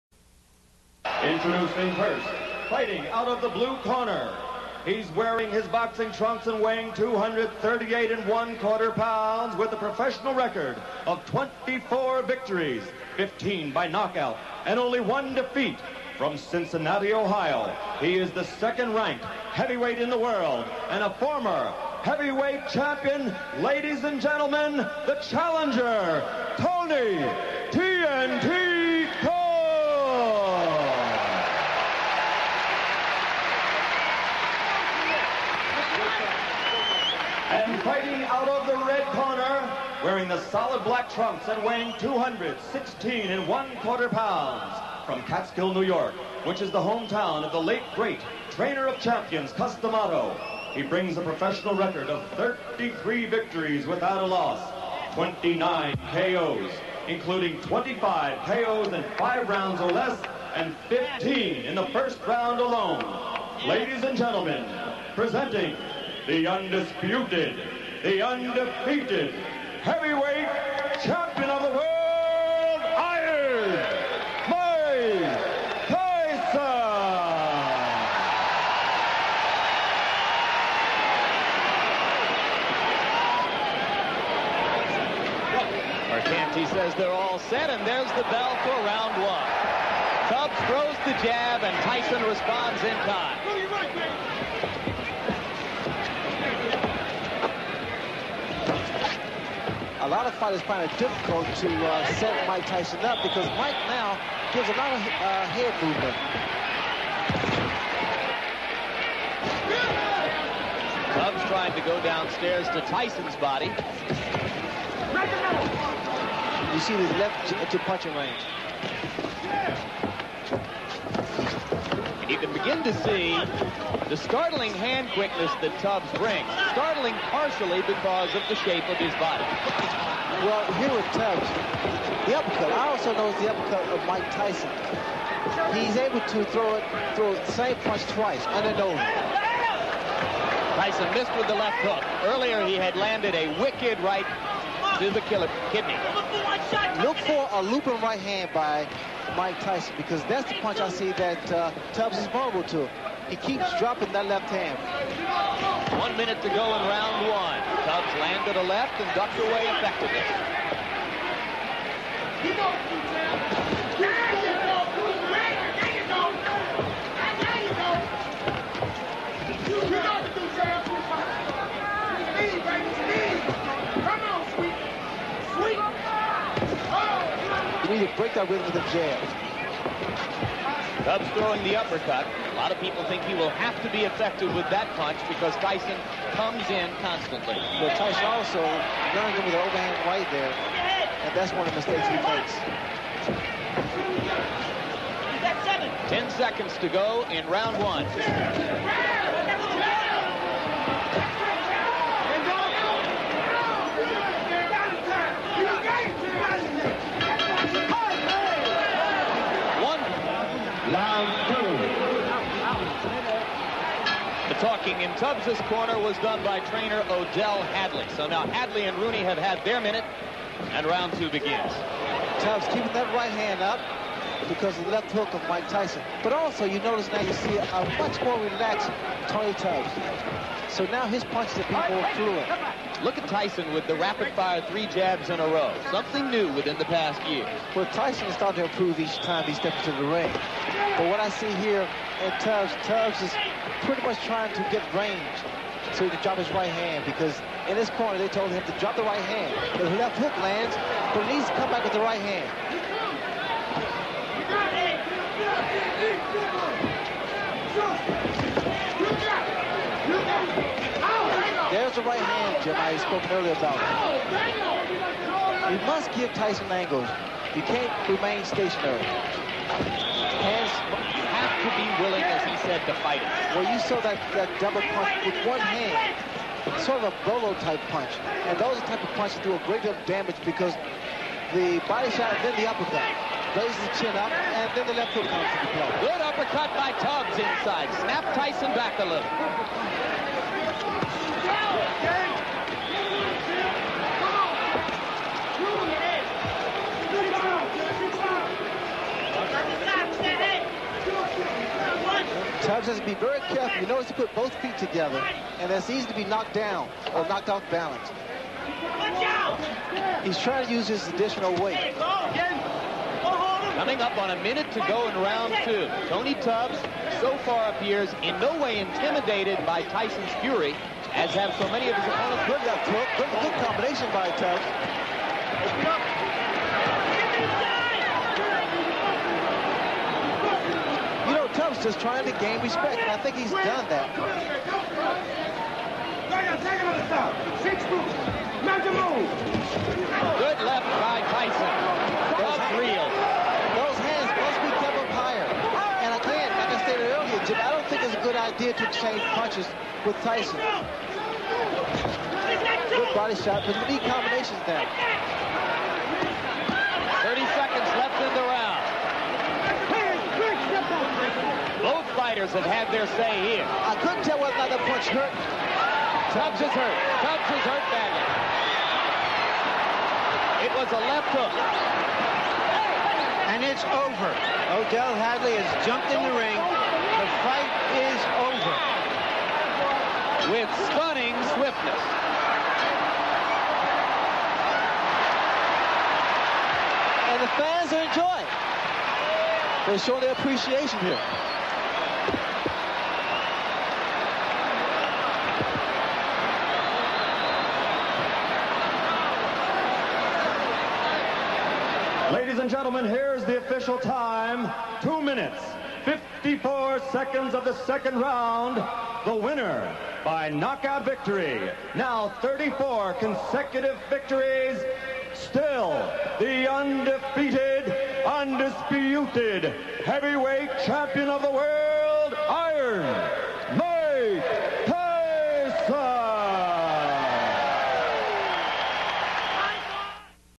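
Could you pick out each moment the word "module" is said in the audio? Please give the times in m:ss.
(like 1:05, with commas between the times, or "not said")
not said.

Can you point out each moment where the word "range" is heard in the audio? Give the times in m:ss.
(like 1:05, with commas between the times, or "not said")
1:58, 4:04.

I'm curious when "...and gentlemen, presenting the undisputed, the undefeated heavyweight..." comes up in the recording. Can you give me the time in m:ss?
1:04.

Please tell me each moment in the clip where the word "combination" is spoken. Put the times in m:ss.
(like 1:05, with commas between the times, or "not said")
5:23, 5:54.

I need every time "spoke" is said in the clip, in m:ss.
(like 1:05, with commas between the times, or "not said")
4:22.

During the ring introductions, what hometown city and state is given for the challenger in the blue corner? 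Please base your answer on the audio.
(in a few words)
Cincinnati, Ohio.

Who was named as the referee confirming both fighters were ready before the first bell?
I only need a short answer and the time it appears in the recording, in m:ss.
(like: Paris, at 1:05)
Mercante, at 1:26.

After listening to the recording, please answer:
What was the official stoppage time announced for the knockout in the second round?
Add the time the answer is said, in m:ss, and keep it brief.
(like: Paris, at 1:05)
2:54, at 6:45.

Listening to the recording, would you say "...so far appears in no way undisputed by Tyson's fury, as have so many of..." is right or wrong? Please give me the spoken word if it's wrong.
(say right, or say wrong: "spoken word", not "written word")
wrong: "intimidated", not "undisputed".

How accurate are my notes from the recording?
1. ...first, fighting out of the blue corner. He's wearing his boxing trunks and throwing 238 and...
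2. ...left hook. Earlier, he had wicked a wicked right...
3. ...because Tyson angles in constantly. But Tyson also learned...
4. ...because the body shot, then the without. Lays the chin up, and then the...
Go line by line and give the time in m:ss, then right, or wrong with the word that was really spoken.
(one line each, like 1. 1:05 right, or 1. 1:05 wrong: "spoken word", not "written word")
1. 0:01 wrong: "weighing", not "throwing"
2. 2:21 wrong: "landed", not "wicked"
3. 3:05 wrong: "comes", not "angles"
4. 4:40 wrong: "uppercut", not "without".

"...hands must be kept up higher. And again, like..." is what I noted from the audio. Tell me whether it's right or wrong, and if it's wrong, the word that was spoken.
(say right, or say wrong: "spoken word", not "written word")
right.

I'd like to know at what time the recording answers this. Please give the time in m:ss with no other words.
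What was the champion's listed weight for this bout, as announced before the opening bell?
0:41.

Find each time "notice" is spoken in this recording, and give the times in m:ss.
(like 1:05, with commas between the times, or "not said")
3:46, 5:03.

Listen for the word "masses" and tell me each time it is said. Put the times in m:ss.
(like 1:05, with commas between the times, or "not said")
not said.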